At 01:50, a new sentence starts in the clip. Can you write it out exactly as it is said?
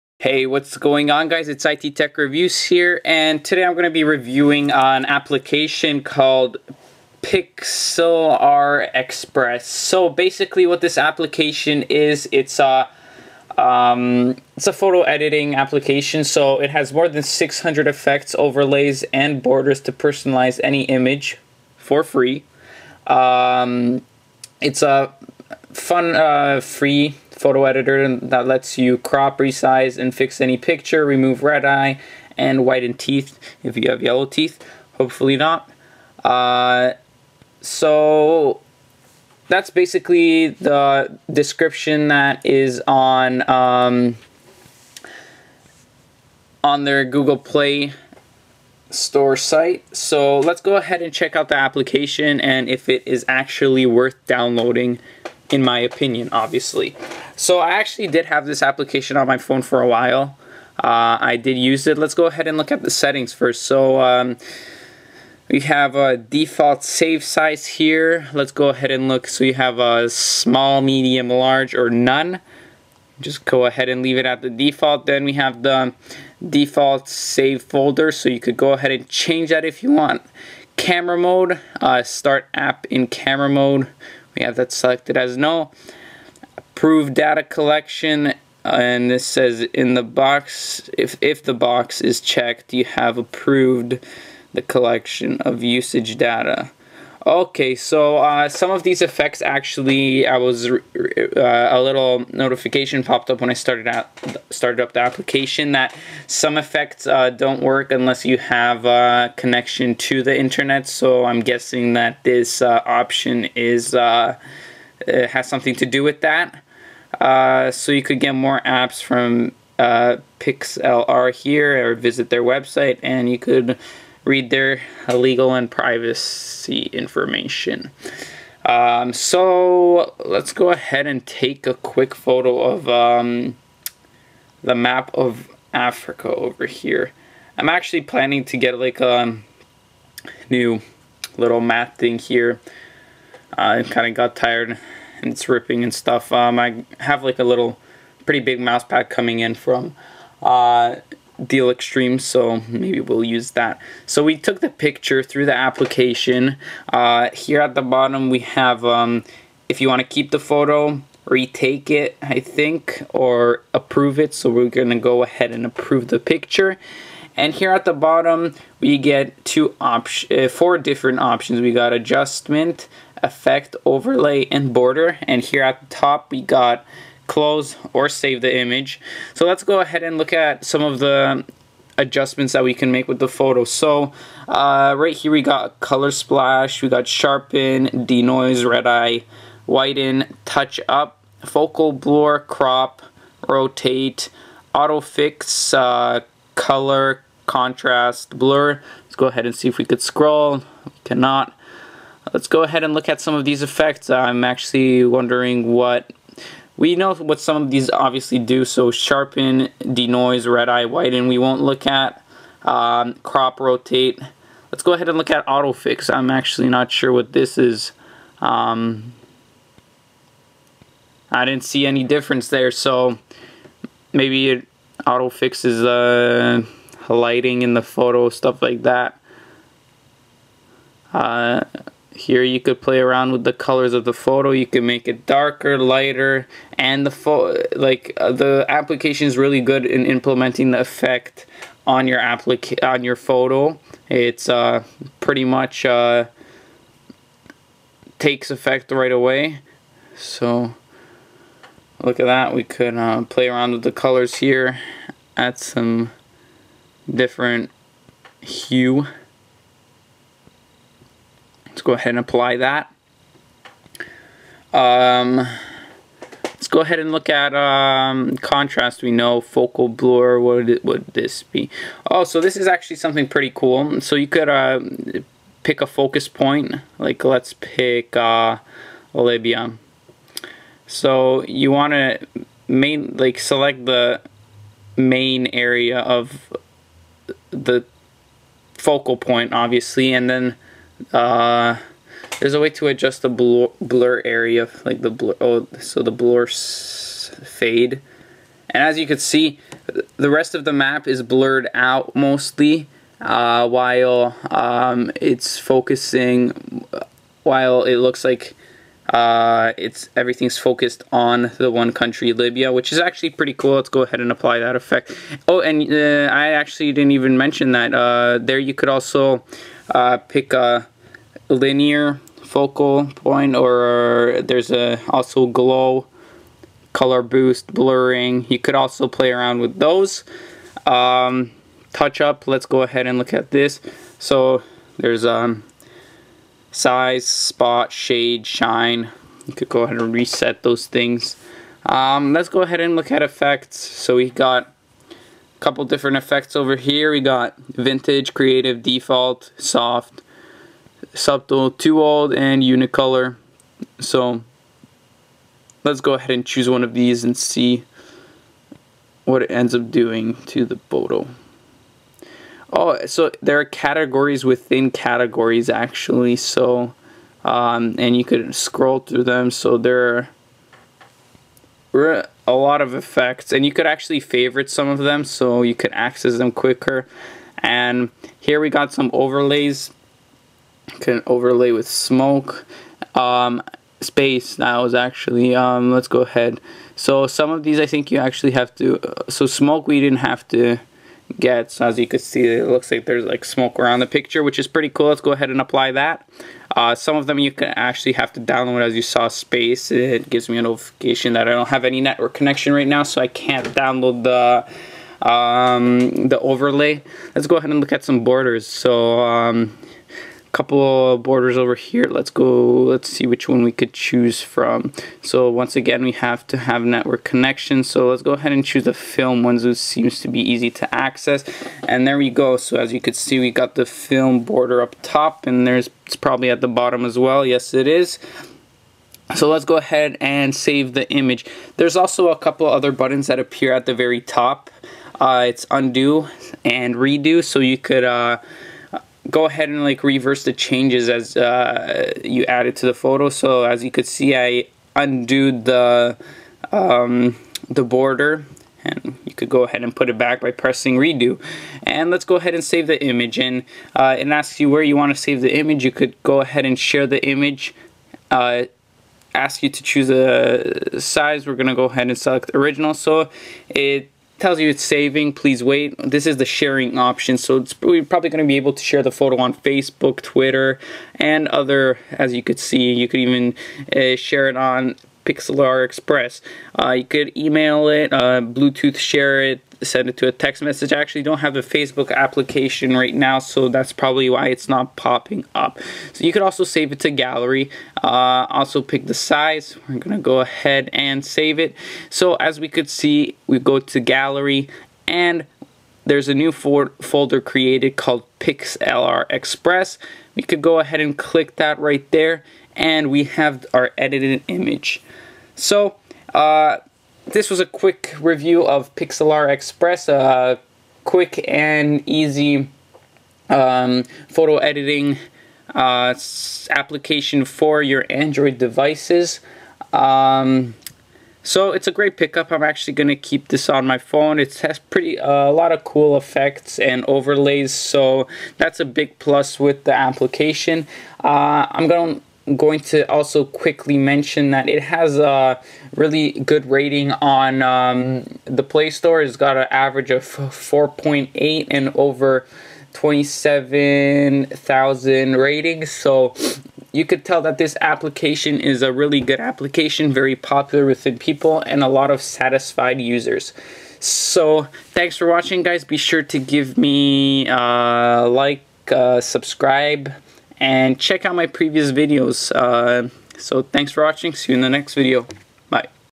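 So I'm guessing that this uh, option is uh, has something to do with that.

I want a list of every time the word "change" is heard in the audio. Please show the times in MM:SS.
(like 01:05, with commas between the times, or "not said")
01:19, 07:20.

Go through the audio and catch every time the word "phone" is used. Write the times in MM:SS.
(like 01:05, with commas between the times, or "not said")
00:59, 08:43.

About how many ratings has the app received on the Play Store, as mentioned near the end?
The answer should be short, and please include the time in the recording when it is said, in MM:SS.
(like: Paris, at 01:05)
over 27,000, at 09:01.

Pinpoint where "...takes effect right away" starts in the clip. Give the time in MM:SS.
04:08.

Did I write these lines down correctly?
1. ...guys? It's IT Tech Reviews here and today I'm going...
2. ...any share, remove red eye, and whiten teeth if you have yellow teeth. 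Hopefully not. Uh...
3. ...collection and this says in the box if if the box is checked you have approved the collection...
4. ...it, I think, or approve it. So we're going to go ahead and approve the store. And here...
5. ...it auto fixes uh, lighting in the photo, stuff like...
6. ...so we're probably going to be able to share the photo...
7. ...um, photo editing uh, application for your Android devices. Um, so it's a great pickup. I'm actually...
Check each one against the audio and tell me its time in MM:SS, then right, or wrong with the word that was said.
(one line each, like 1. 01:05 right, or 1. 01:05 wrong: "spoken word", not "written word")
1. 00:01 right
2. 00:30 wrong: "picture", not "share"
3. 01:27 right
4. 02:41 wrong: "picture", not "store"
5. 03:44 right
6. 07:47 right
7. 08:33 right.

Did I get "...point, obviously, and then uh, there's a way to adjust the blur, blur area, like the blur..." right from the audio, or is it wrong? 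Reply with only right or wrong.
right.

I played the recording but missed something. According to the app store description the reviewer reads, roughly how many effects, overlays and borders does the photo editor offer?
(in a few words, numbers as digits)
more than 600.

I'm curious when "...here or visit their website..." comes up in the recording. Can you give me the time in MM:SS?
02:01.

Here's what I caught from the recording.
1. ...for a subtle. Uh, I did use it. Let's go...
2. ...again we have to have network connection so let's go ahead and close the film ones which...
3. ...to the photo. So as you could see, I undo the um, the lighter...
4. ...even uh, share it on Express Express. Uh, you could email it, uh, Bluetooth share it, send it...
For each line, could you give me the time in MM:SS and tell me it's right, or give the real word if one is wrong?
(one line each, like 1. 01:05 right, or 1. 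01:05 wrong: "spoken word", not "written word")
1. 00:59 wrong: "while", not "subtle"
2. 06:55 wrong: "choose", not "close"
3. 07:22 wrong: "border", not "lighter"
4. 07:53 wrong: "Pixlr", not "Express".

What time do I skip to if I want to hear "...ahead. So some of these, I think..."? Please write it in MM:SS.
06:26.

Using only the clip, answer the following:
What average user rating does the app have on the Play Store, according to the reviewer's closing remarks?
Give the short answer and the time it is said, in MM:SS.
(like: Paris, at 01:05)
4.8, at 09:00.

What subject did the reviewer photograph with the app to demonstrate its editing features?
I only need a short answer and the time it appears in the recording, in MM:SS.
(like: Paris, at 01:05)
map of Africa, at 02:14.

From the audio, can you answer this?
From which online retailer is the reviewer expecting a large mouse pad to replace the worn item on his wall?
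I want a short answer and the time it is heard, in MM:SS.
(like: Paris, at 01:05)
Deal Extreme, at 02:31.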